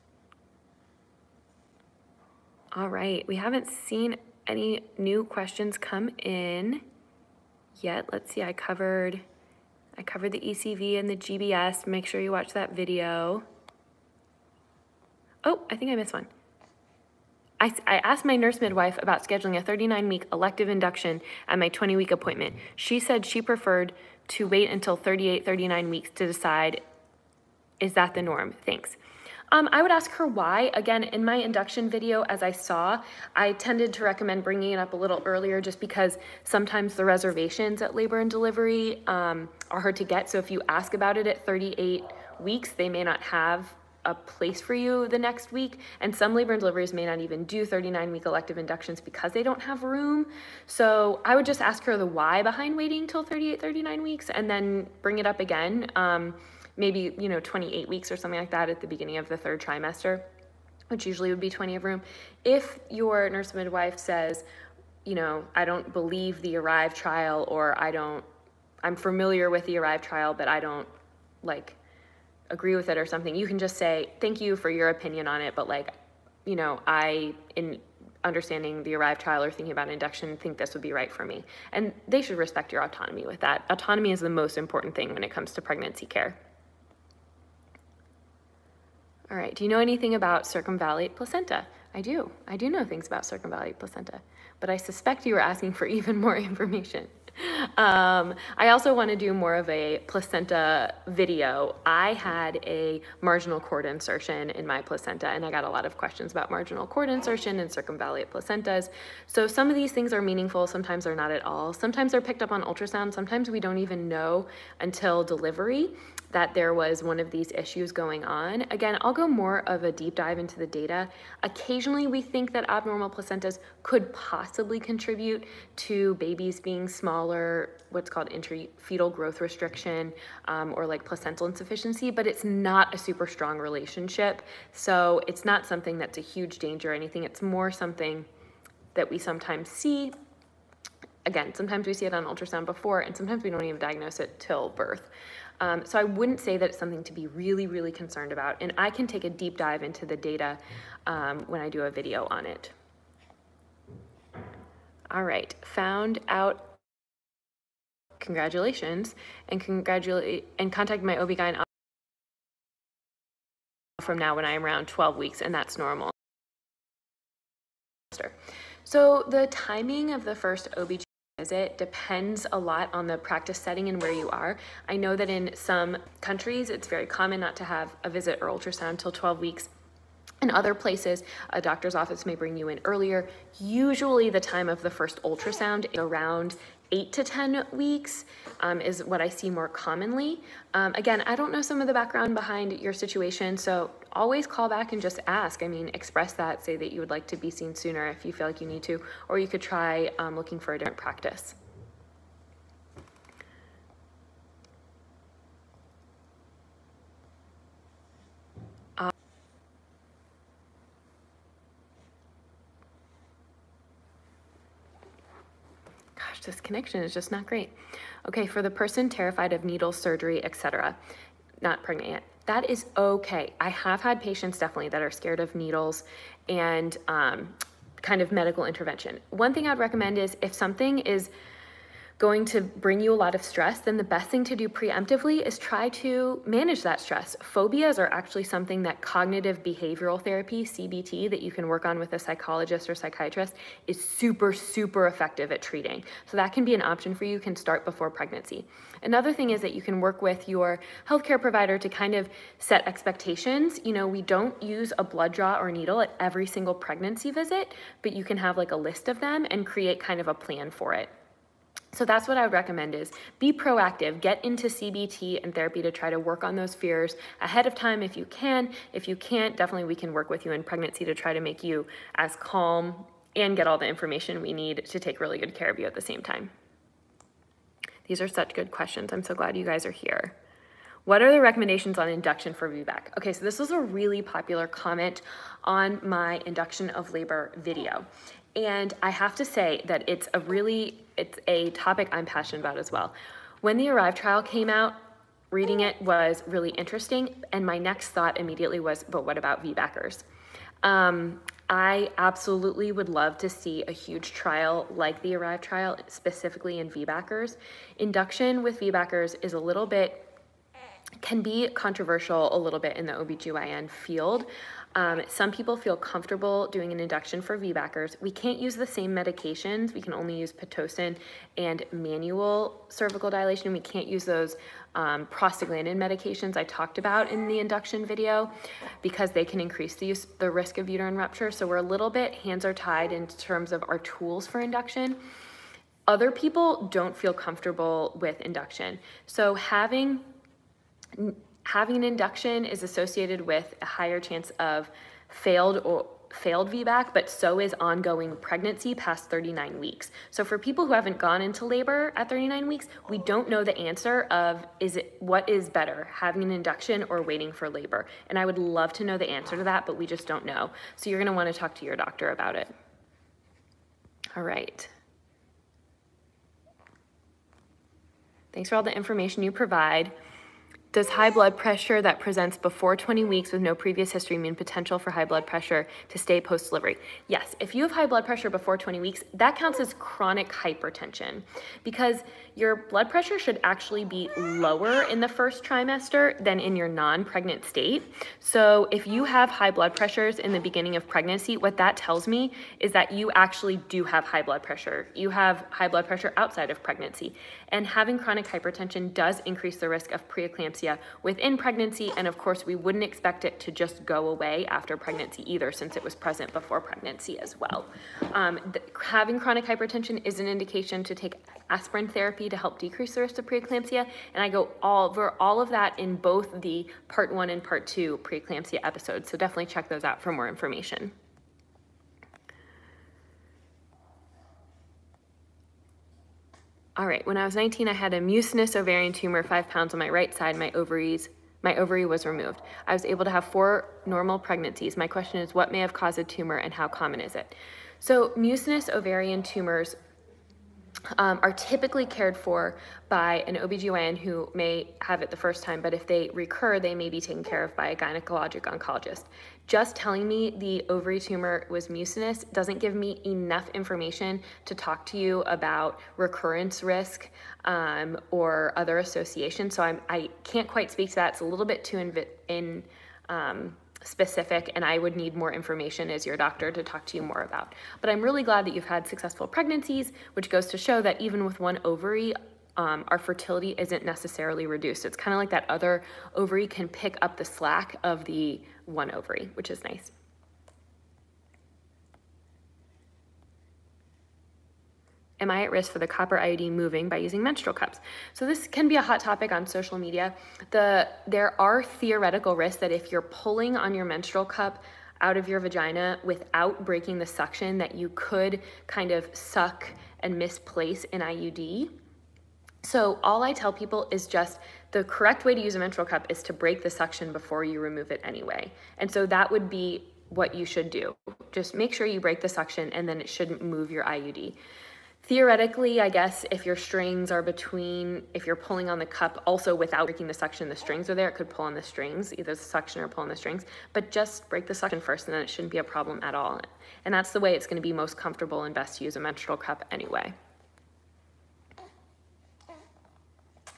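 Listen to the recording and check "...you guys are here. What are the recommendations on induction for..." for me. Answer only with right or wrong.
right.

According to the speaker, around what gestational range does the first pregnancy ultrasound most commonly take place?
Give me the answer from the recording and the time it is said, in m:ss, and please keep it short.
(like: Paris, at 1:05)
8 to 10 weeks, at 3:06.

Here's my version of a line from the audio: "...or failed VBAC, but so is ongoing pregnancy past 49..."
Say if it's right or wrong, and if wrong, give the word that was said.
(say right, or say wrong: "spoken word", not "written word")
wrong: "39", not "49".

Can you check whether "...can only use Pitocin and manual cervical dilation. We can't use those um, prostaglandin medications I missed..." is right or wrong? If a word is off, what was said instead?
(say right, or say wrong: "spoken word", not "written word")
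wrong: "talked", not "missed".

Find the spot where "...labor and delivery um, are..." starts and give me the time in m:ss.
0:37.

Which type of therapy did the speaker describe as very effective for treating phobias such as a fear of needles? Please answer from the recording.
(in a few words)
Cognitive behavioral therapy.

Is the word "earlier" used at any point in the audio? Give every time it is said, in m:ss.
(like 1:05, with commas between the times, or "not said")
0:35, 3:02.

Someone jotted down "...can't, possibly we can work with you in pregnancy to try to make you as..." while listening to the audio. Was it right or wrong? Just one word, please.
wrong.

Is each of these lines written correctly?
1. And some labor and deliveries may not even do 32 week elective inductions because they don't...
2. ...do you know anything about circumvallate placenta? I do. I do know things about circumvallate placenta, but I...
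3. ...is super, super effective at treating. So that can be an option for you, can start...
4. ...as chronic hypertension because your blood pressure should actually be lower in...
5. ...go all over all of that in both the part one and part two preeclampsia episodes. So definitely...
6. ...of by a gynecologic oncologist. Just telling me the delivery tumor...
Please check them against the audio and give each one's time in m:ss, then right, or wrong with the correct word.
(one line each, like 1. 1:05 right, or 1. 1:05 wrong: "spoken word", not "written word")
1. 0:45 wrong: "39", not "32"
2. 1:29 right
3. 4:03 right
4. 6:19 right
5. 6:54 right
6. 7:27 wrong: "ovary", not "delivery".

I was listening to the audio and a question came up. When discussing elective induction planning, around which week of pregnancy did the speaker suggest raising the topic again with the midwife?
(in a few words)
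28 weeks.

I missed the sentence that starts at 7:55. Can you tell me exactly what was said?
It's kind of like that other ovary can pick up the slack of the one ovary, which is nice.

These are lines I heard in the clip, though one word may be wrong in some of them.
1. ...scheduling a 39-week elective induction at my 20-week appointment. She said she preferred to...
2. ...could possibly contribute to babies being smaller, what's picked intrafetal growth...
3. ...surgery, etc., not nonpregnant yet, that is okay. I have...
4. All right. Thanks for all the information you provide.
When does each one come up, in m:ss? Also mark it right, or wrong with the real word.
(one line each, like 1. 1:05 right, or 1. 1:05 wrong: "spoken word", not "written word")
1. 0:19 right
2. 2:03 wrong: "called", not "picked"
3. 3:39 wrong: "pregnant", not "nonpregnant"
4. 6:04 right.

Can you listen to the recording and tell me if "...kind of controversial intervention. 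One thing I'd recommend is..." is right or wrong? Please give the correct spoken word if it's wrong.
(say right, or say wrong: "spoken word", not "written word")
wrong: "medical", not "controversial".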